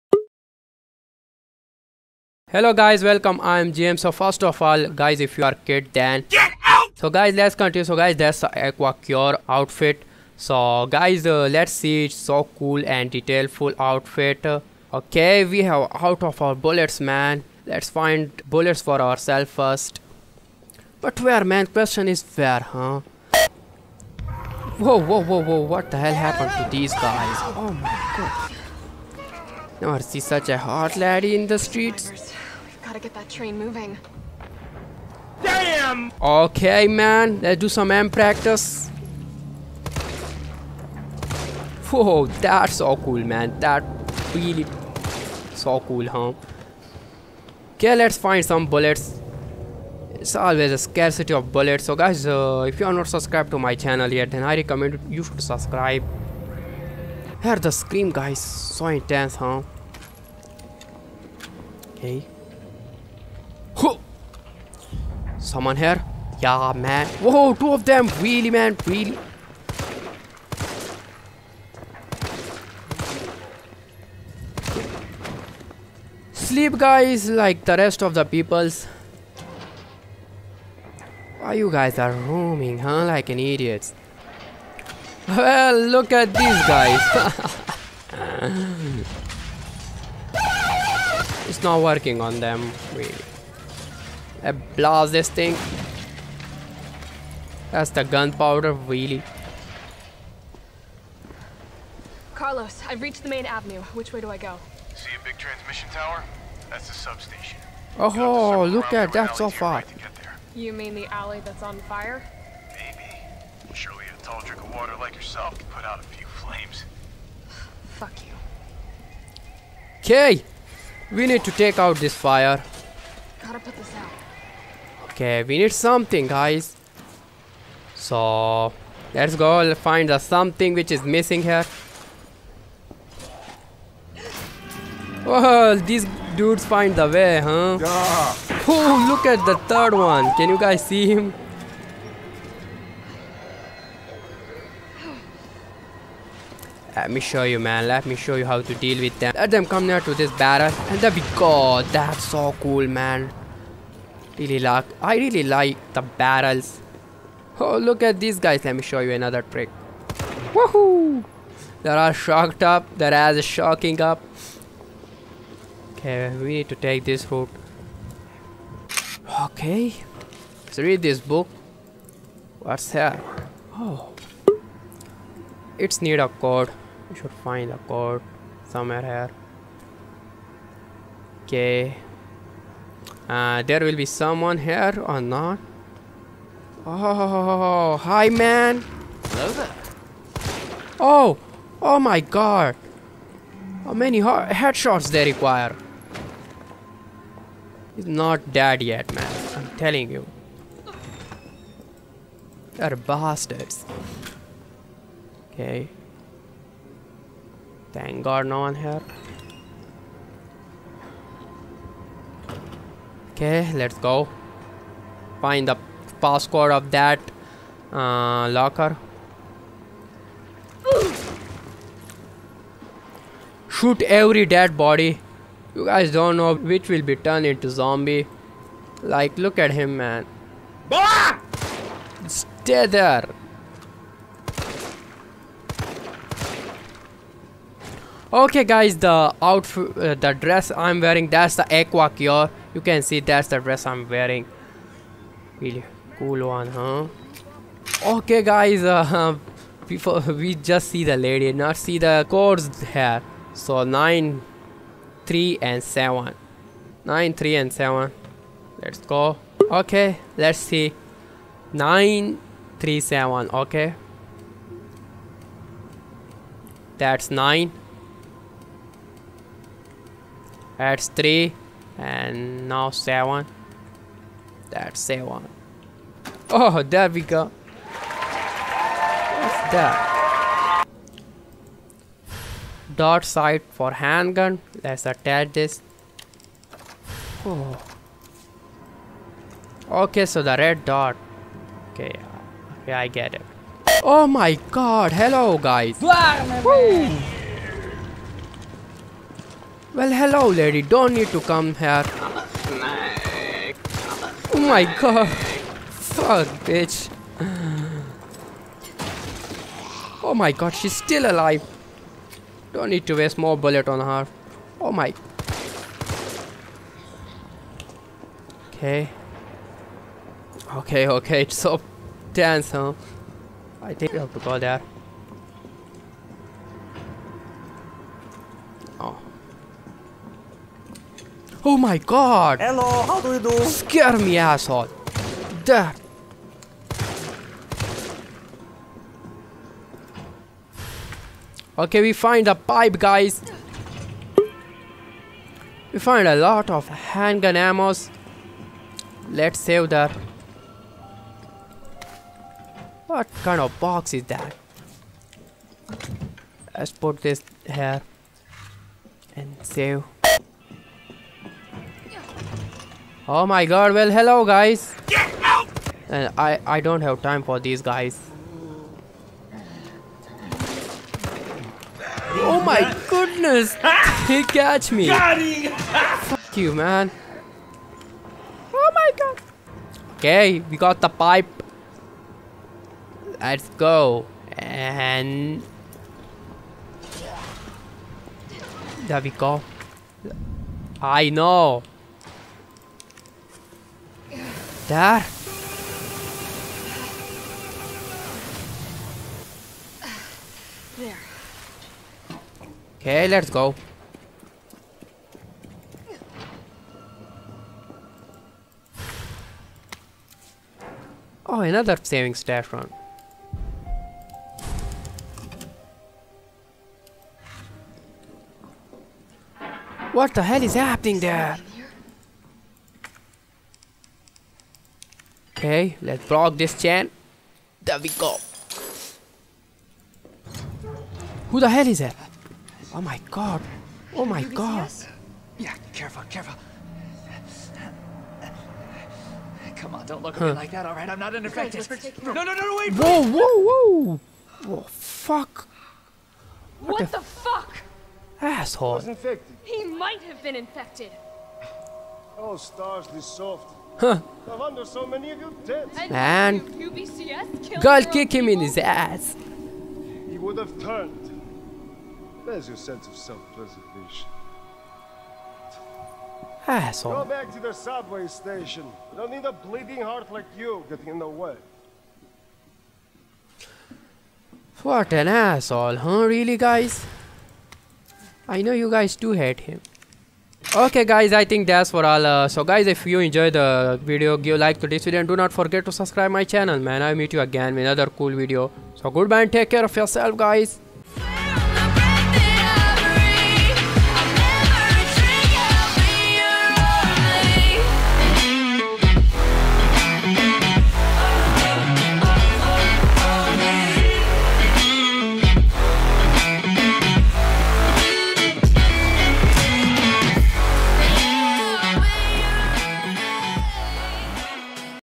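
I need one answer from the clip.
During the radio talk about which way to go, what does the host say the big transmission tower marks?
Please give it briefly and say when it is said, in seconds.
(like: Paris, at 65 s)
The substation, at 106 s.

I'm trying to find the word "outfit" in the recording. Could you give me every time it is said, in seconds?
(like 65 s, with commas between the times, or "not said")
9 s, 13 s, 239 s.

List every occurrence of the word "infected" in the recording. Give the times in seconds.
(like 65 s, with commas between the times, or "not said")
441 s, 450 s.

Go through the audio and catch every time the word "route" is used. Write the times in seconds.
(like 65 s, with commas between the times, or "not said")
167 s.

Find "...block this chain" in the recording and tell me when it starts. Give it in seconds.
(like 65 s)
426 s.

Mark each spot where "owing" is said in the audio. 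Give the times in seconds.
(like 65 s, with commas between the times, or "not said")
not said.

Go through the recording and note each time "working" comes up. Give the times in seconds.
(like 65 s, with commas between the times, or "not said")
91 s.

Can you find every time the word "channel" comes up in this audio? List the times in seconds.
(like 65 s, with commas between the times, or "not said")
53 s, 486 s.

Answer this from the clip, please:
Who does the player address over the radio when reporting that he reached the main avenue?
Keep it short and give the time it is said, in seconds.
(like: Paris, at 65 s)
Carlos, at 102 s.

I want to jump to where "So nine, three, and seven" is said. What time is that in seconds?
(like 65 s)
253 s.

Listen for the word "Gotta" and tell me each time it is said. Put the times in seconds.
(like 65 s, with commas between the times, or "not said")
32 s, 123 s.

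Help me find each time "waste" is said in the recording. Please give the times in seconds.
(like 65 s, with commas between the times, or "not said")
313 s.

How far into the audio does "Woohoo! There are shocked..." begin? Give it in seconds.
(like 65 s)
160 s.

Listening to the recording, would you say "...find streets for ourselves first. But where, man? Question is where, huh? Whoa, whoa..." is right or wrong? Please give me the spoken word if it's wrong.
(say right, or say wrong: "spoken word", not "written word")
wrong: "bullets", not "streets".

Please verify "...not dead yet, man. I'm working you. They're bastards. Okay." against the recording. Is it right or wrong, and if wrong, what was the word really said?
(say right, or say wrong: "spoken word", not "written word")
wrong: "telling", not "working".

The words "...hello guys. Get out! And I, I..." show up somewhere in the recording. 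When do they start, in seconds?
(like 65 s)
364 s.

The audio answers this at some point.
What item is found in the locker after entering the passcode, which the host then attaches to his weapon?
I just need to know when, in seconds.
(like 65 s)
282 s.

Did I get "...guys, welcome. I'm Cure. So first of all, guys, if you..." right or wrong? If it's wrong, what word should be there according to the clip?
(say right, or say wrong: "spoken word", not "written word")
wrong: "James", not "Cure".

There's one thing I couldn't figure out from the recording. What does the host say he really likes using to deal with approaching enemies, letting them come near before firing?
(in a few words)
Barrels.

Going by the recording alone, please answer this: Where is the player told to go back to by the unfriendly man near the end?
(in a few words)
The subway station.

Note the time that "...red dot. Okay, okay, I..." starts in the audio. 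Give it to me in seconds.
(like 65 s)
290 s.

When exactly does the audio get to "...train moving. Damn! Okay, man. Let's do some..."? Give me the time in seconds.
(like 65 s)
33 s.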